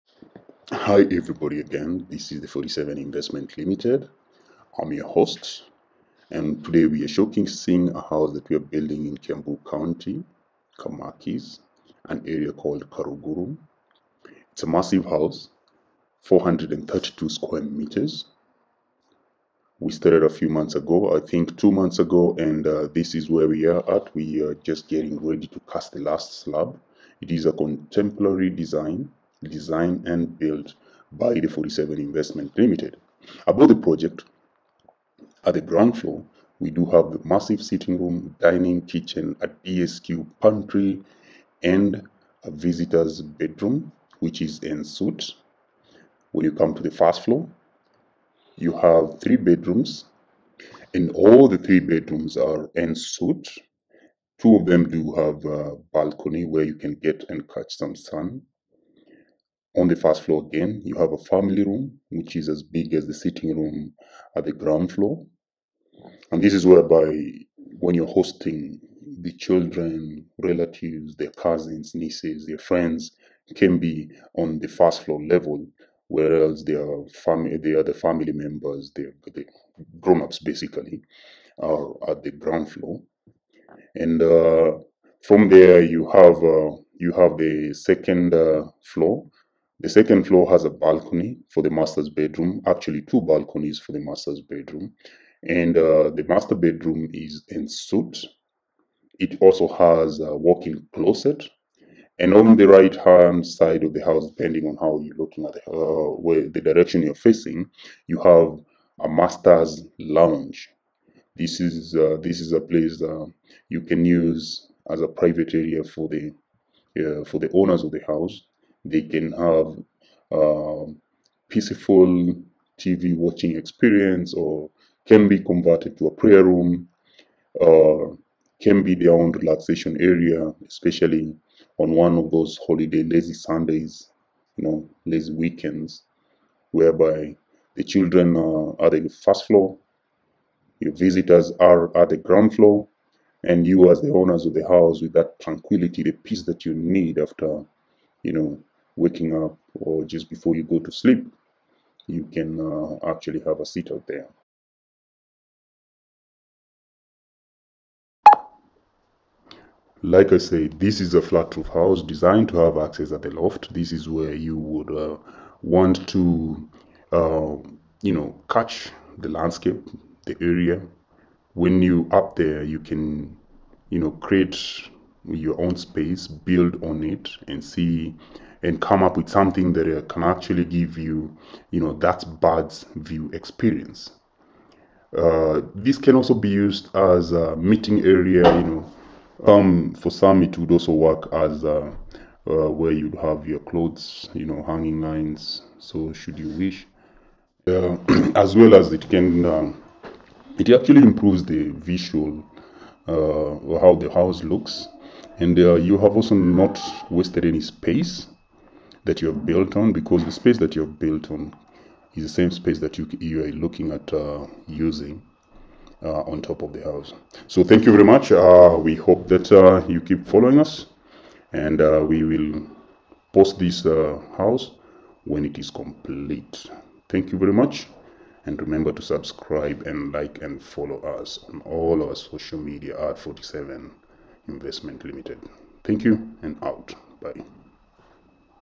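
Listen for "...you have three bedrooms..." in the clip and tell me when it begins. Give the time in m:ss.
0:48.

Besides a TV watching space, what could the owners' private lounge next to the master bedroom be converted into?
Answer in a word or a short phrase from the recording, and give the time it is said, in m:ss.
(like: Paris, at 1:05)
Prayer room, at 2:06.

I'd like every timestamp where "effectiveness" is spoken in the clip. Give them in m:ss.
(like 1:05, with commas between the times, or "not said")
not said.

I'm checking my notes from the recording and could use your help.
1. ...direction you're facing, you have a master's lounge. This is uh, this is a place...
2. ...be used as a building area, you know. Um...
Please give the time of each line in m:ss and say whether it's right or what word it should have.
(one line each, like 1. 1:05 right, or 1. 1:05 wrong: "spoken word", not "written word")
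1. 1:46 right
2. 3:06 wrong: "meeting", not "building".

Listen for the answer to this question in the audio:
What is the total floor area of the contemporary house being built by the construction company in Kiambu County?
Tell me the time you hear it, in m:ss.
0:16.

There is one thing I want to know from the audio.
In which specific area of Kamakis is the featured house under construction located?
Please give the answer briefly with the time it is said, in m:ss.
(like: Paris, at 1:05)
Karuguru, at 0:12.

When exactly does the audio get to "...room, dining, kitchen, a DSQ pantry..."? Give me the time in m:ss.
0:37.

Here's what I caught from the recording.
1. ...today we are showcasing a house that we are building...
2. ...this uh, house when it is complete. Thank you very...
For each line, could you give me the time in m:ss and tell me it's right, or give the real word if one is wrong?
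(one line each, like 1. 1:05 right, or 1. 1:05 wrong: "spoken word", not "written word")
1. 0:06 right
2. 3:43 right.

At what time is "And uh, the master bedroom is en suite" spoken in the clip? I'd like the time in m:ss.
1:35.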